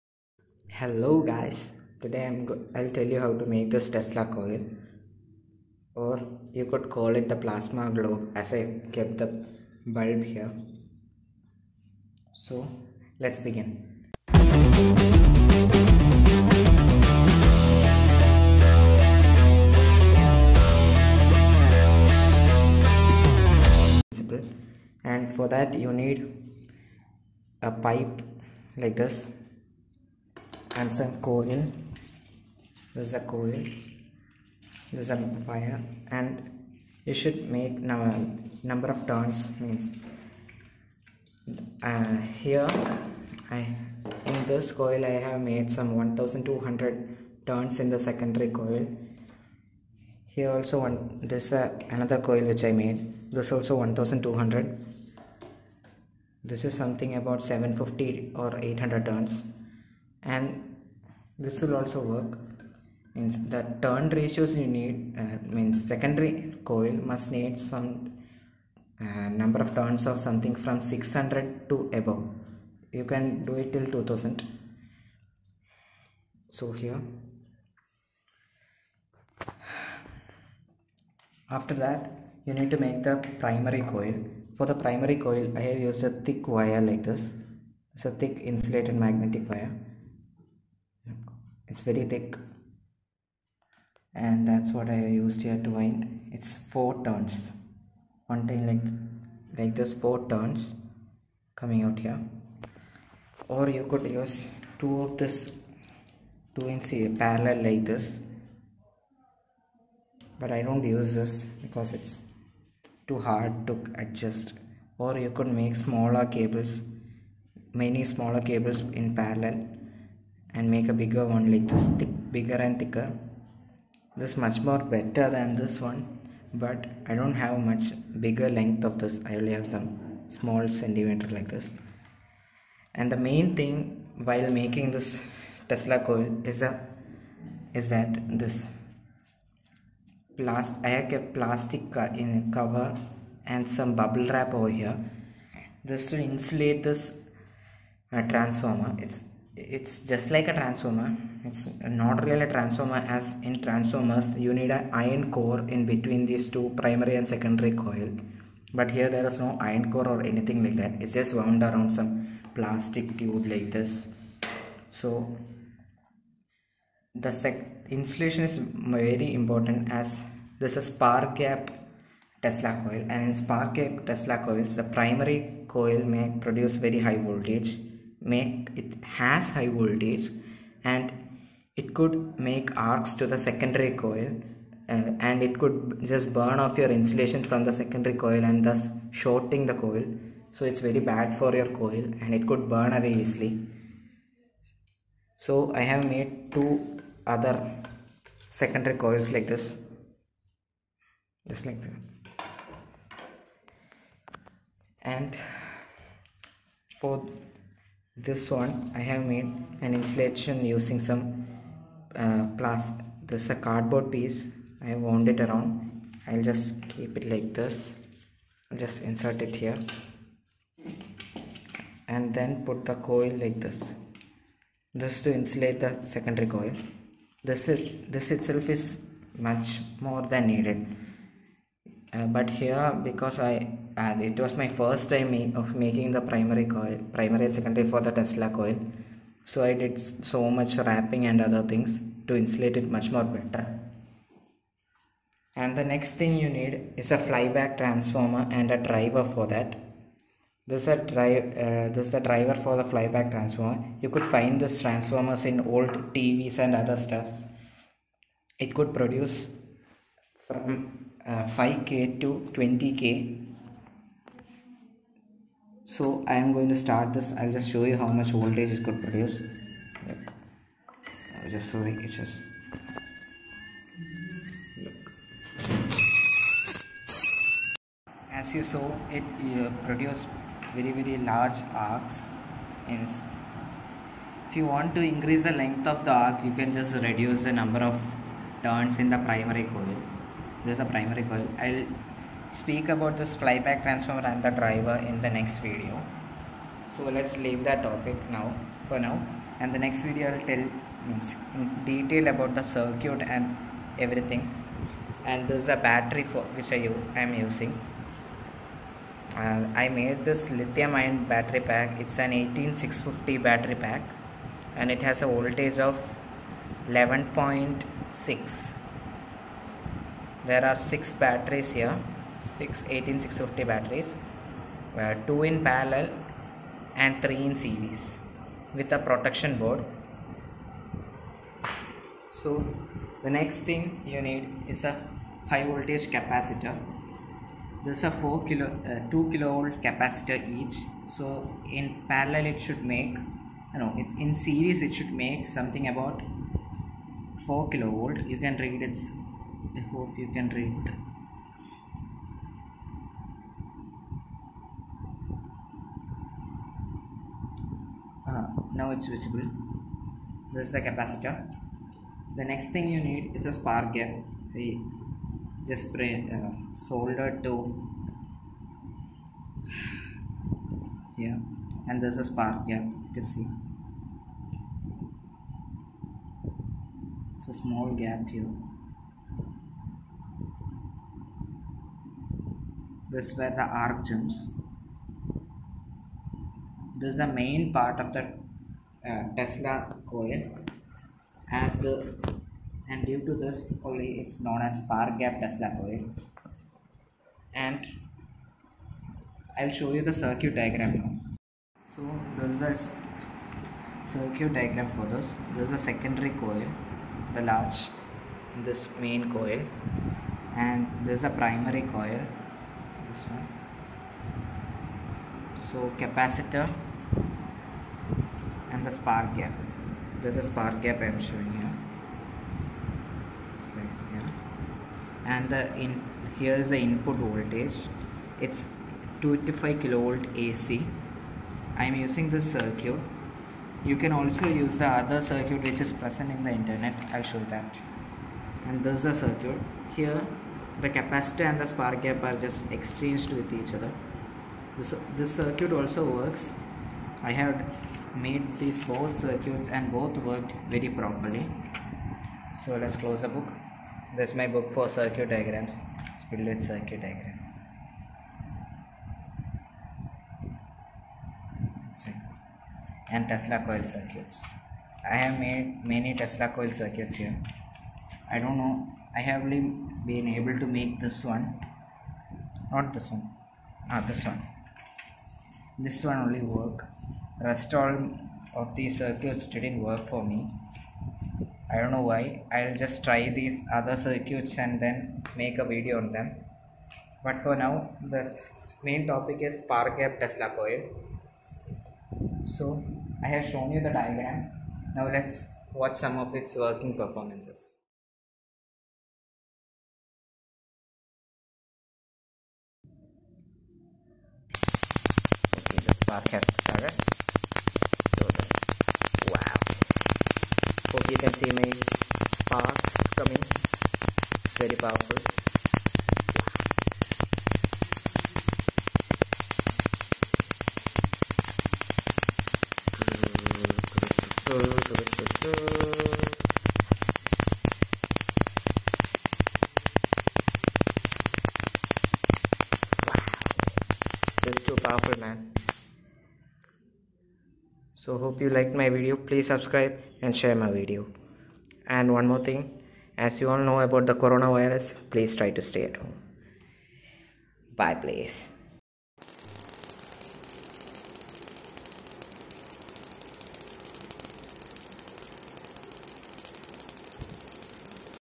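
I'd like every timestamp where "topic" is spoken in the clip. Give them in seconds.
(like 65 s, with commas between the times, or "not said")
297 s, 489 s.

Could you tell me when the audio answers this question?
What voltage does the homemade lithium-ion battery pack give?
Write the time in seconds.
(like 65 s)
316 s.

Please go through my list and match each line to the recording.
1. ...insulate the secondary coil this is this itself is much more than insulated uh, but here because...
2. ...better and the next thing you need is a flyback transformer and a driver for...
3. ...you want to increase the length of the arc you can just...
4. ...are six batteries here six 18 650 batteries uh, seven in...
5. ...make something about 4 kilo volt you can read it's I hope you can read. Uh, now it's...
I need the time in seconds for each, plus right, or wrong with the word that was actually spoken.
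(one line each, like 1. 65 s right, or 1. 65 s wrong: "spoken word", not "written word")
1. 225 s wrong: "needed", not "insulated"
2. 243 s right
3. 284 s right
4. 320 s wrong: "two", not "seven"
5. 345 s right.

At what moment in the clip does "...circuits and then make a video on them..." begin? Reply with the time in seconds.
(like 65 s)
483 s.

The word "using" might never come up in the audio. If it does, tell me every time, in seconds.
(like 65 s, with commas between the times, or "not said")
210 s, 307 s, 432 s.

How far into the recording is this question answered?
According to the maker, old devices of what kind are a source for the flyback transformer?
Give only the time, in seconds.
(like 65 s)
255 s.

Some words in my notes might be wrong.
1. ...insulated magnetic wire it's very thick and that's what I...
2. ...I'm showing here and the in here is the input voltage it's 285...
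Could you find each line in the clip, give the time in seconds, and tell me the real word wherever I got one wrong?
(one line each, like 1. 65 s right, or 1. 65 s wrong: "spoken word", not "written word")
1. 88 s right
2. 421 s right.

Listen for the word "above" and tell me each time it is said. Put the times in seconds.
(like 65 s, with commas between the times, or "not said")
71 s.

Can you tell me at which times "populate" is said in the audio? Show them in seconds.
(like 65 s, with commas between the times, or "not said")
not said.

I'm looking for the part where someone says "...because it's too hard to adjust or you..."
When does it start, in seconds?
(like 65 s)
111 s.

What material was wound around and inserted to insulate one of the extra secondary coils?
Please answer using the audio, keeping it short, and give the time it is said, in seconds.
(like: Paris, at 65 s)
cardboard, at 213 s.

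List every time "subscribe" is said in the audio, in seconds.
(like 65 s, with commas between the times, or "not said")
539 s.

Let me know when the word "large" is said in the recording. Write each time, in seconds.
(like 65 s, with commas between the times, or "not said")
281 s, 407 s.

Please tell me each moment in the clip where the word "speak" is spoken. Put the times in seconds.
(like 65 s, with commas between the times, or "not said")
292 s.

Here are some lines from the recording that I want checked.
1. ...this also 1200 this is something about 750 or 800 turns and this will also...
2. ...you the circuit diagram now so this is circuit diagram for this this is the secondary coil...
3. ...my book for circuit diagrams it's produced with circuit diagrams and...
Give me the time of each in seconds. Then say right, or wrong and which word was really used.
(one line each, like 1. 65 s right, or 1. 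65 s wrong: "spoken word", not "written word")
1. 53 s right
2. 399 s right
3. 454 s wrong: "filled", not "produced".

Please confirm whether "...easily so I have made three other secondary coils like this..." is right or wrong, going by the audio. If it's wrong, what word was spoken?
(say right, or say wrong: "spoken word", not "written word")
wrong: "two", not "three".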